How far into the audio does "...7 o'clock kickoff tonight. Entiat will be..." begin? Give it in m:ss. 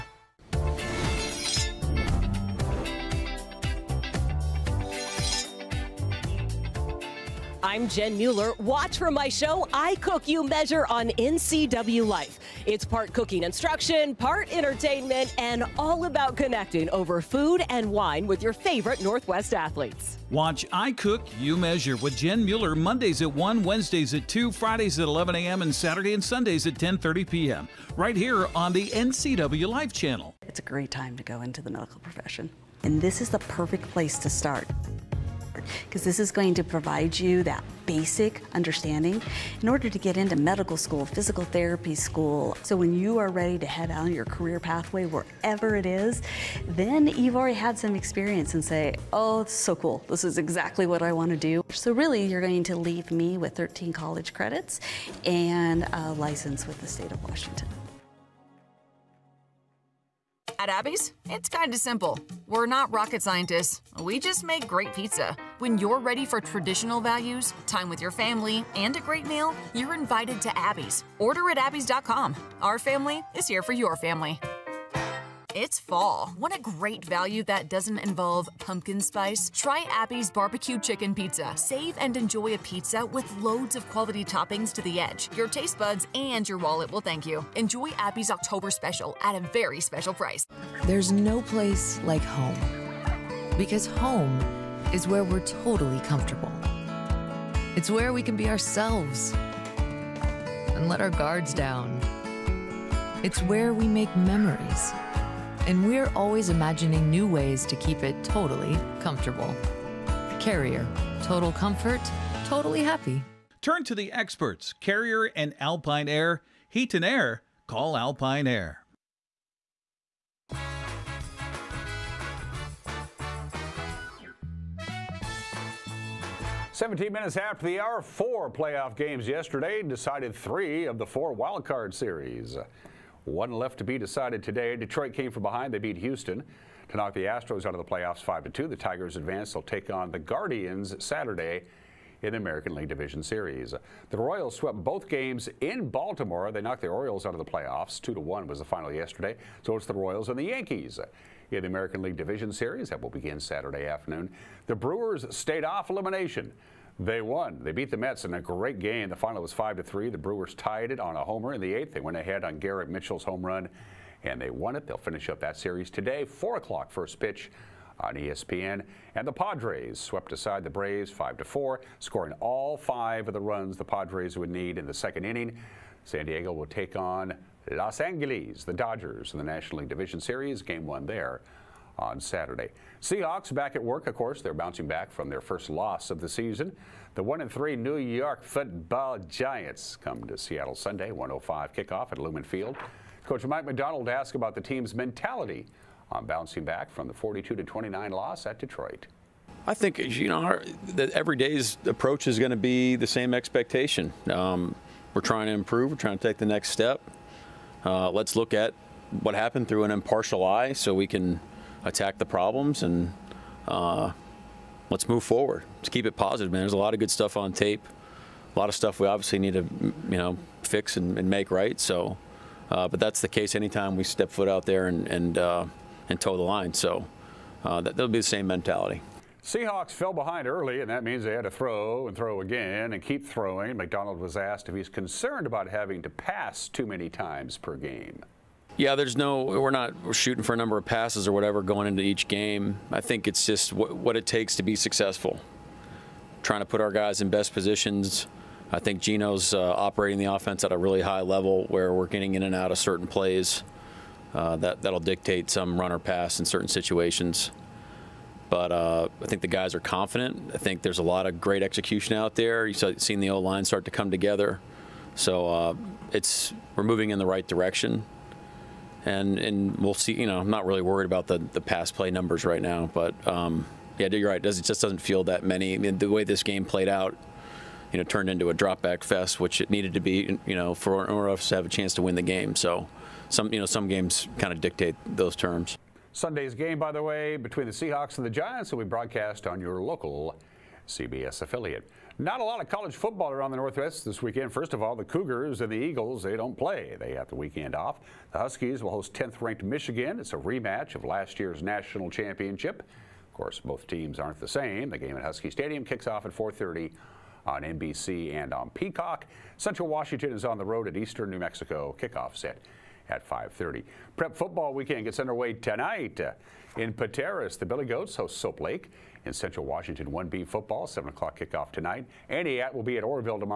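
5:20.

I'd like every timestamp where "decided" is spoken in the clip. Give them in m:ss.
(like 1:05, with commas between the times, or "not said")
2:09, 2:13.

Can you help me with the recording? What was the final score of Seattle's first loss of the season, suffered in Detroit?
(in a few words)
42-29.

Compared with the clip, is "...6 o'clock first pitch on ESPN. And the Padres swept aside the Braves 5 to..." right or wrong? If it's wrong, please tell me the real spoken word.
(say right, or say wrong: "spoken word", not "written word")
wrong: "4", not "6".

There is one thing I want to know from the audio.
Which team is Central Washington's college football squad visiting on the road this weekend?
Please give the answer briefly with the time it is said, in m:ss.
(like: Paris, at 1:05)
Eastern New Mexico, at 5:10.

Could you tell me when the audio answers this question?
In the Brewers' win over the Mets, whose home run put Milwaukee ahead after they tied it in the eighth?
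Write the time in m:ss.
2:42.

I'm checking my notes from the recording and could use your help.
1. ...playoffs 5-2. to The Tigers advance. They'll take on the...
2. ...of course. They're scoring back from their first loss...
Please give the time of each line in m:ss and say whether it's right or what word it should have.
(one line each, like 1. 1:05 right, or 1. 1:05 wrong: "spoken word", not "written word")
1. 2:17 right
2. 3:04 wrong: "bouncing", not "scoring".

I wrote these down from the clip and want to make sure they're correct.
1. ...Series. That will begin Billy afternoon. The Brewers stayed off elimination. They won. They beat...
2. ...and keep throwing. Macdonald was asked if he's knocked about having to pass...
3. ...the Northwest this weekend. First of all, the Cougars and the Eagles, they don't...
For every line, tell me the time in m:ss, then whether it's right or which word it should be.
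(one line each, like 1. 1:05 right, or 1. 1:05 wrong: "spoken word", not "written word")
1. 2:32 wrong: "Saturday", not "Billy"
2. 3:52 wrong: "concerned", not "knocked"
3. 4:53 right.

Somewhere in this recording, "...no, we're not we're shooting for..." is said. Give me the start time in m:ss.
3:59.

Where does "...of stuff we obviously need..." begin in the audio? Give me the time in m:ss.
3:38.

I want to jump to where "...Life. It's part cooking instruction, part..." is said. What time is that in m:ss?
0:12.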